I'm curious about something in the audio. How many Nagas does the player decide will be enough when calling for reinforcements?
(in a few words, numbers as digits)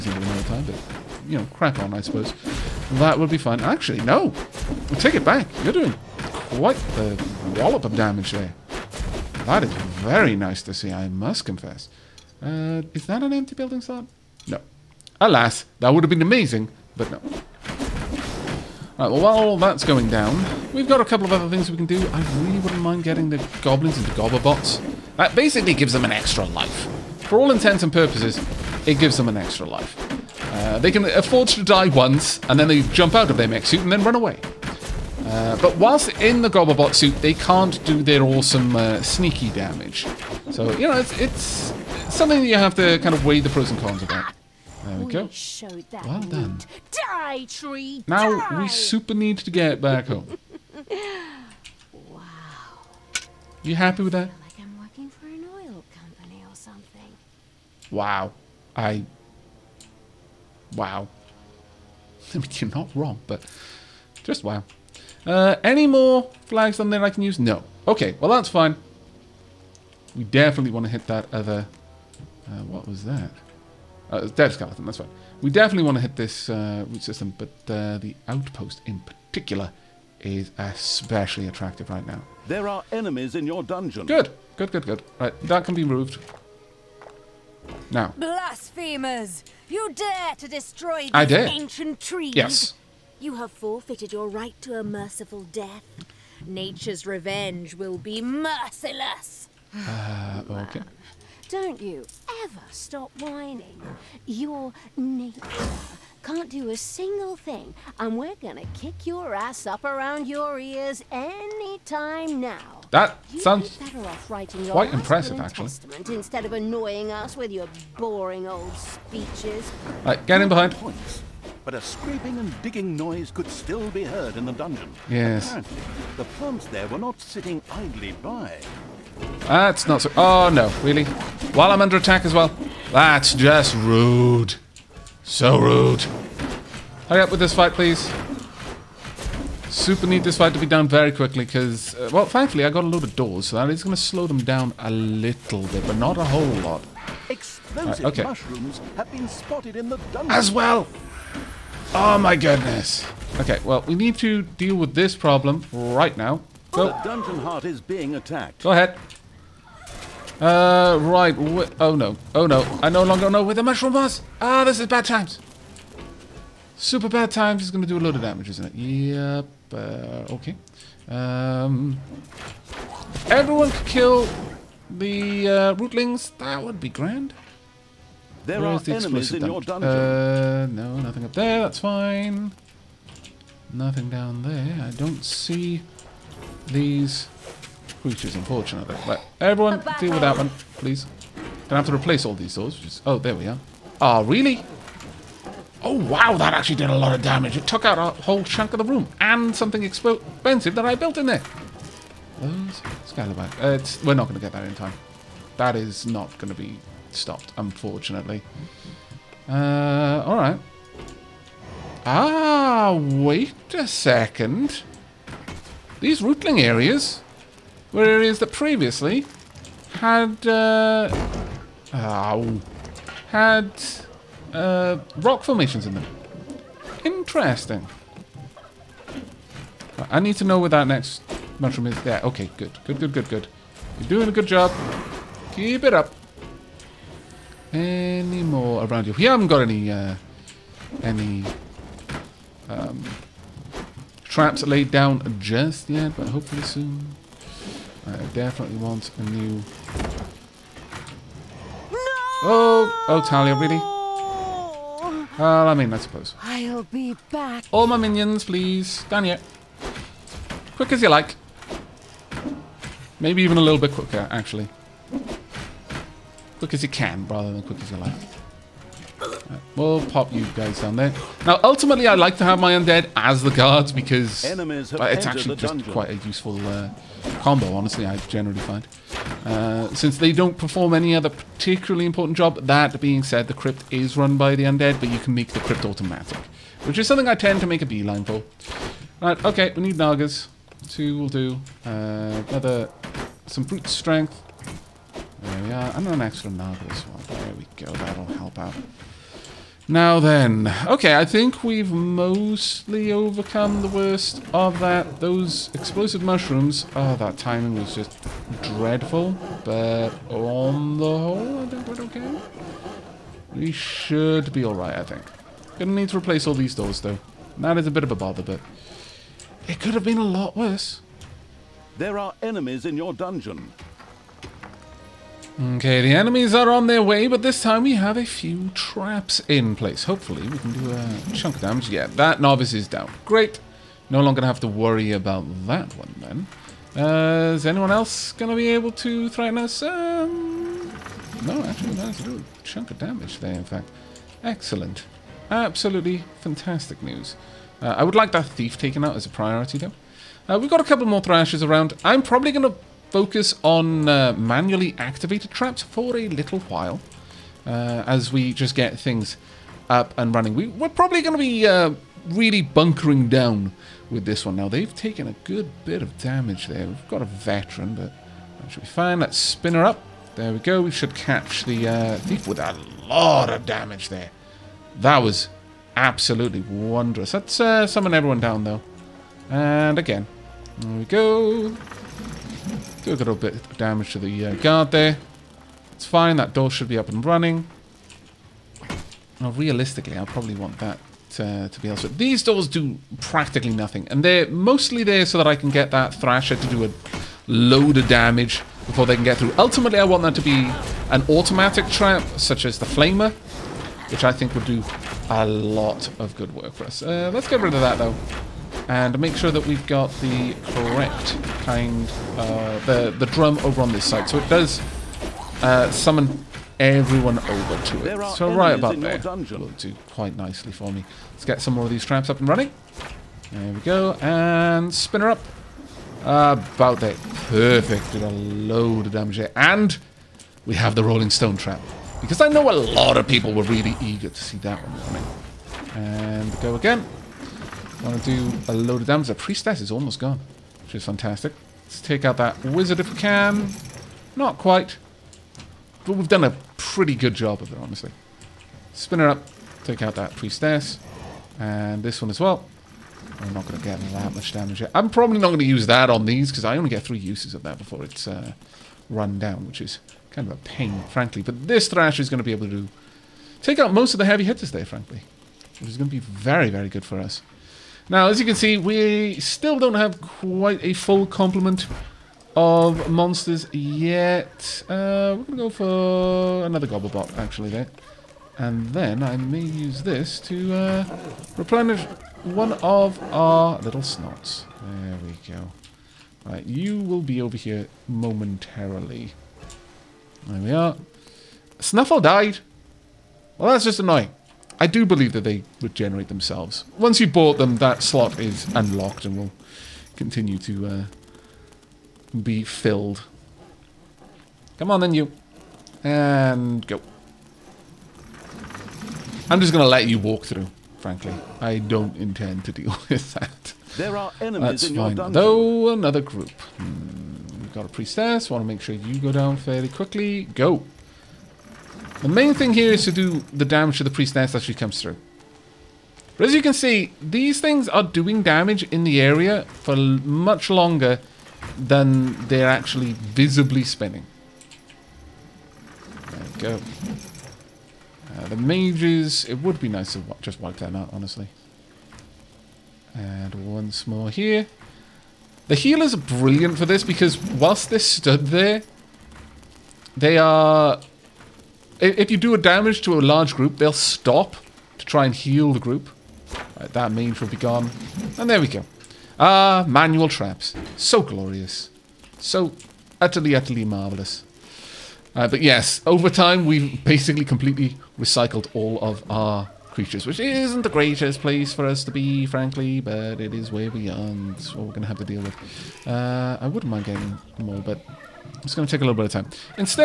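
2.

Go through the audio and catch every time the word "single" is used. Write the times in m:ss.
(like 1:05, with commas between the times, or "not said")
1:46.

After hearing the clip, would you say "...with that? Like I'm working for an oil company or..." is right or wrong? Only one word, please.
right.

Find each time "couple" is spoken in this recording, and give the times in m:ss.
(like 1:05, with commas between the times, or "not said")
0:21, 5:50.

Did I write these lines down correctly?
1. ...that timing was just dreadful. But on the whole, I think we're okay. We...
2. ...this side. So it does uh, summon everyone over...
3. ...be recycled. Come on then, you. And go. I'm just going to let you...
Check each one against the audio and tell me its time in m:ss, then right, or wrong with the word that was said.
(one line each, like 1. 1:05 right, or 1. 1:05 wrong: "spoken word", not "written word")
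1. 5:07 right
2. 6:53 right
3. 8:22 wrong: "filled", not "recycled".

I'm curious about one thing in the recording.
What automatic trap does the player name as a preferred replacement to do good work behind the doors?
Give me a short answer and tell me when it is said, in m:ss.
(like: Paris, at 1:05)
The Flamer, at 6:42.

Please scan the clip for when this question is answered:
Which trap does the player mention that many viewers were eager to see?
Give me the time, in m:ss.
7:11.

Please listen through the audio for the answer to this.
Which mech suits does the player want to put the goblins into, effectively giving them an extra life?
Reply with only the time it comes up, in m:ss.
0:24.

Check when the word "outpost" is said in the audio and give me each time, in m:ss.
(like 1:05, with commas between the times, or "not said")
1:18.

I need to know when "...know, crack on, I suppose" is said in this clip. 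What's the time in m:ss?
0:01.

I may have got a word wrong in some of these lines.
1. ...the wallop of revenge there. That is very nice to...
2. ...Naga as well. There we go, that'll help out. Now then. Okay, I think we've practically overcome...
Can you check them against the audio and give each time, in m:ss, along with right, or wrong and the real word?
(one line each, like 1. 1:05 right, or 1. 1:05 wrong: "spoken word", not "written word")
1. 0:06 wrong: "damage", not "revenge"
2. 4:56 wrong: "mostly", not "practically".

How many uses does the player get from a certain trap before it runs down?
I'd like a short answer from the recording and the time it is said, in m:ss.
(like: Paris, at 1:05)
3, at 7:37.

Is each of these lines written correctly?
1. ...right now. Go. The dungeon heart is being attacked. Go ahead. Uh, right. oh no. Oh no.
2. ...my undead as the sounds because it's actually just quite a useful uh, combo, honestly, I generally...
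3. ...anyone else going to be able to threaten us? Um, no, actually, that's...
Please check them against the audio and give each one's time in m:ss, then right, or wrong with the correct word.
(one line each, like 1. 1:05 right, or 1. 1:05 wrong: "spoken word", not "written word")
1. 2:35 right
2. 4:32 wrong: "guards", not "sounds"
3. 5:37 right.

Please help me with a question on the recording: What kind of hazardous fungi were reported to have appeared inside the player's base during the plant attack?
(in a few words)
Explosive mushrooms.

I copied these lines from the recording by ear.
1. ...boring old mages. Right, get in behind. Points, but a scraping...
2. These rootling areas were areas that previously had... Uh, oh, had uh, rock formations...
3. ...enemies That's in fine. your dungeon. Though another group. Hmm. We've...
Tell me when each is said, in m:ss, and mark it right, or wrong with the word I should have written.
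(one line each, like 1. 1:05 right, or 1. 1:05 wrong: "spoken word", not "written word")
1. 1:57 wrong: "speeches", not "mages"
2. 3:35 right
3. 8:34 right.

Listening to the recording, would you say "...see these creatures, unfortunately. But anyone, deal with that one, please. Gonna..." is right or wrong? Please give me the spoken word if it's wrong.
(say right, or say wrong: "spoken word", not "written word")
wrong: "everyone", not "anyone".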